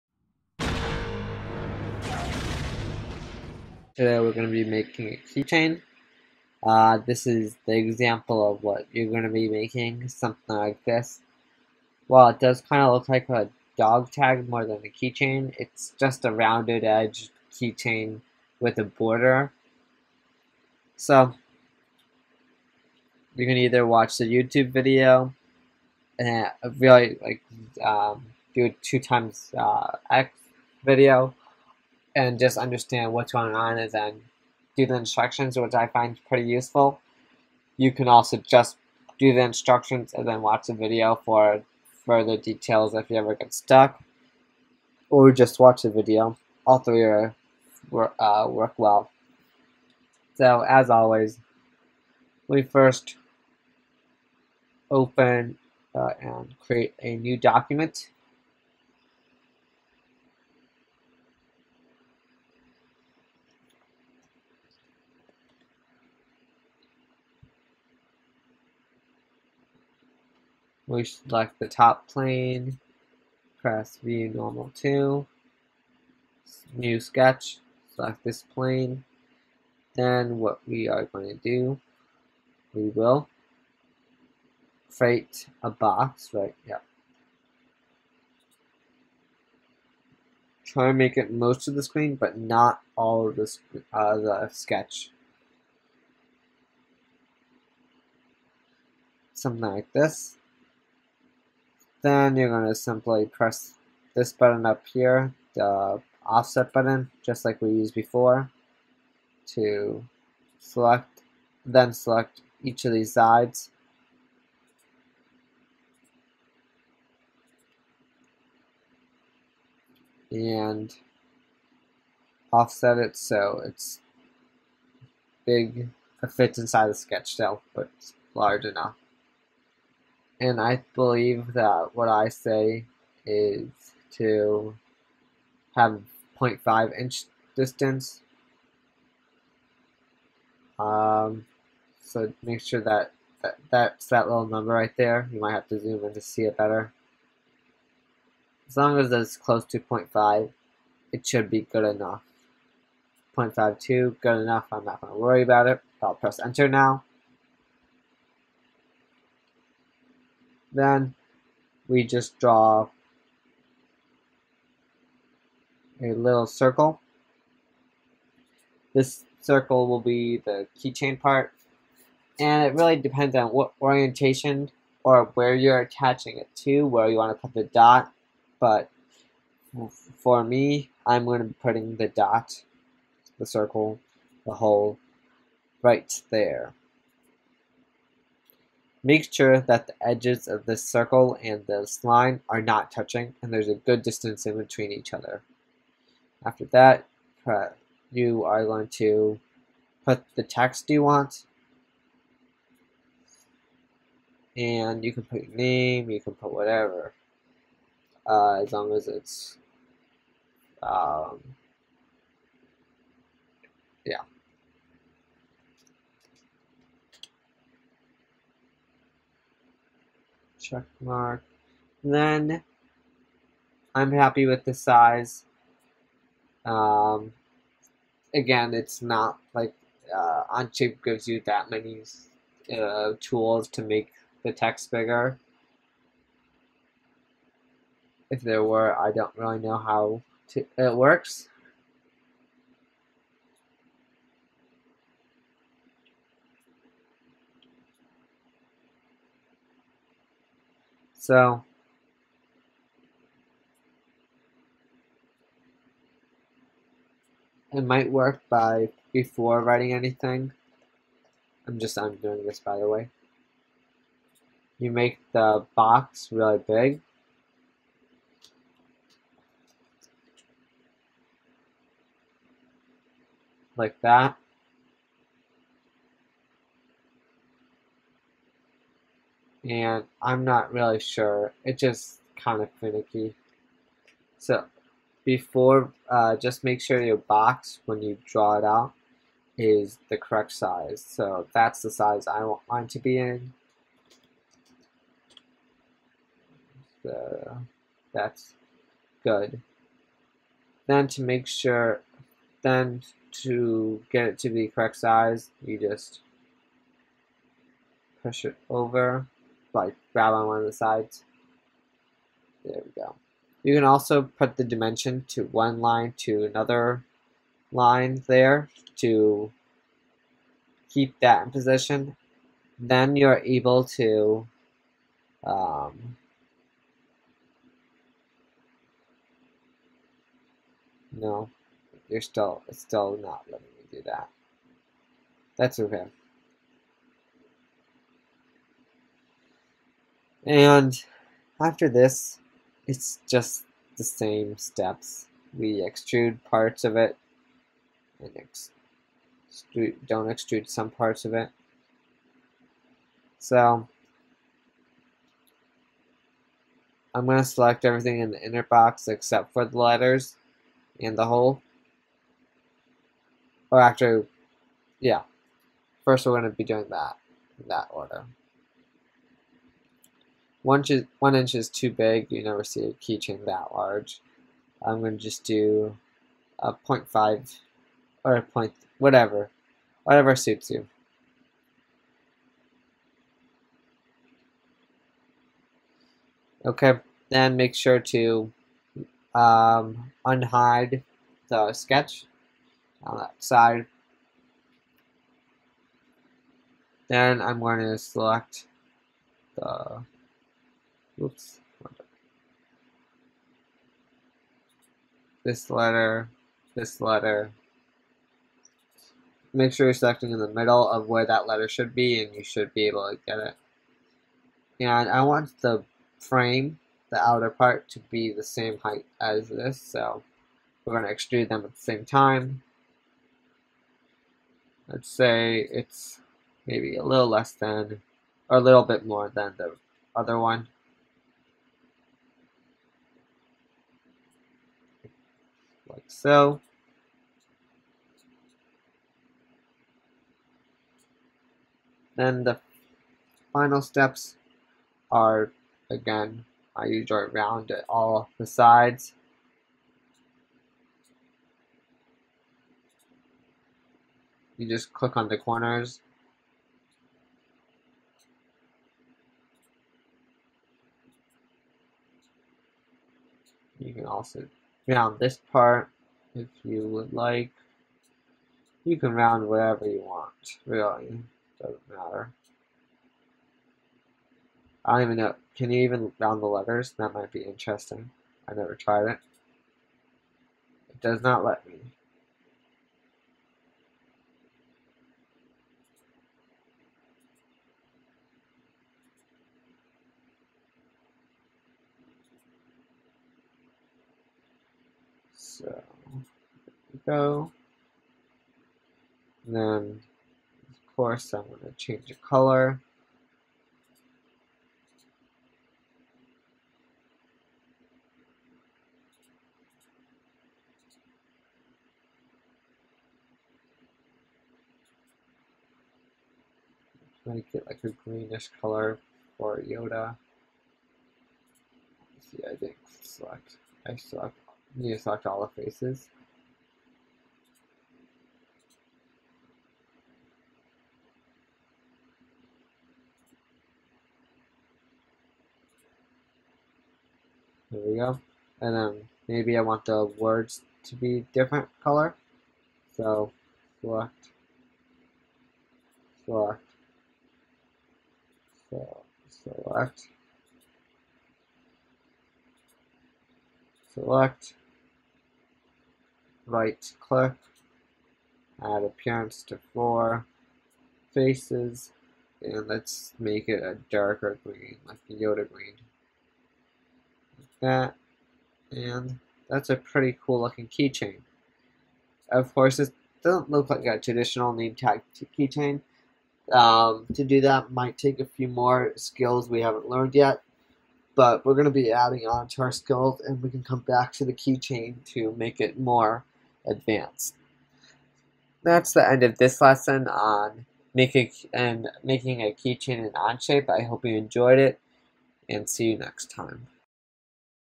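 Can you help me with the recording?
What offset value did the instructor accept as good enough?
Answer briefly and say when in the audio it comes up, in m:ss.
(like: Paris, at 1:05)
0.52, at 2:33.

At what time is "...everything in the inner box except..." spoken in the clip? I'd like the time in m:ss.
5:57.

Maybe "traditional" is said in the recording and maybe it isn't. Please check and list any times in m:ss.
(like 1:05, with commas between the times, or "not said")
9:33.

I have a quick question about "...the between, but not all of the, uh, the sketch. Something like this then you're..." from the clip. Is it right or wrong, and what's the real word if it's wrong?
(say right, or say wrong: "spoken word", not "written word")
wrong: "screen", not "between".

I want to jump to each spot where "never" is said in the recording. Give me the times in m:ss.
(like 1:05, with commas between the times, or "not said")
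6:12, 7:58.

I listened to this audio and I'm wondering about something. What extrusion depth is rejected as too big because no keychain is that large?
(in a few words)
1 inch.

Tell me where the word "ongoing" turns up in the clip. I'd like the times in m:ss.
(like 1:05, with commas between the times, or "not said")
not said.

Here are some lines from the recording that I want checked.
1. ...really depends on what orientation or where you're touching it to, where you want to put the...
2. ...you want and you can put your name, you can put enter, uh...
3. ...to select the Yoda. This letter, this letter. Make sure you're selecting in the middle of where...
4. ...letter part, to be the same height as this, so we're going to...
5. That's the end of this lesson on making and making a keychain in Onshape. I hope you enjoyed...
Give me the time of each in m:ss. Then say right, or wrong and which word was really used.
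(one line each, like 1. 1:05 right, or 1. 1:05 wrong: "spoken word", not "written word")
1. 2:52 wrong: "attaching", not "touching"
2. 3:20 wrong: "whatever", not "enter"
3. 6:37 wrong: "Oops", not "Yoda"
4. 6:57 wrong: "outer", not "letter"
5. 9:48 right.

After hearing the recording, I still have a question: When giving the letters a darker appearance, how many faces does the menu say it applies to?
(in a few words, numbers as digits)
4.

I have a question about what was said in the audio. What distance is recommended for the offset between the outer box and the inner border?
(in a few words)
0.5 inch.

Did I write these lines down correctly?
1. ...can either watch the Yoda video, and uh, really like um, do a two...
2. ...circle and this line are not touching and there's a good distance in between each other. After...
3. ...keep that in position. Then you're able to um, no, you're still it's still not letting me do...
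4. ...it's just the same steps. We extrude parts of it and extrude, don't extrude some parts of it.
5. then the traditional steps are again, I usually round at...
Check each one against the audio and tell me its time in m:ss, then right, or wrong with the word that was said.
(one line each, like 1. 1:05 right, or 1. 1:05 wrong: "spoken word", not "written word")
1. 0:23 wrong: "YouTube", not "Yoda"
2. 3:10 right
3. 5:20 right
4. 5:42 right
5. 7:22 wrong: "final", not "traditional".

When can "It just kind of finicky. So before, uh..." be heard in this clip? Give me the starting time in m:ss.
4:41.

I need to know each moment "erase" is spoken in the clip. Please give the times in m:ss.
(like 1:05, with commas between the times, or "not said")
not said.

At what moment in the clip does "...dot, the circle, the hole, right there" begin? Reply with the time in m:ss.
3:02.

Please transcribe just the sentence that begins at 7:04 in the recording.
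Let's say it's maybe a little less than, or a little bit more than the other one.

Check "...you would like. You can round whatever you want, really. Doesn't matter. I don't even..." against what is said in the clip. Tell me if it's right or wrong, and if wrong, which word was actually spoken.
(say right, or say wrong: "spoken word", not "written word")
right.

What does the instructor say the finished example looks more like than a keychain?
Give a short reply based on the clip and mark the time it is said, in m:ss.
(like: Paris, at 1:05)
dog tag, at 0:13.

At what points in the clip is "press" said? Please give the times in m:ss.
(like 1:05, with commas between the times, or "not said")
1:13, 1:43, 2:36.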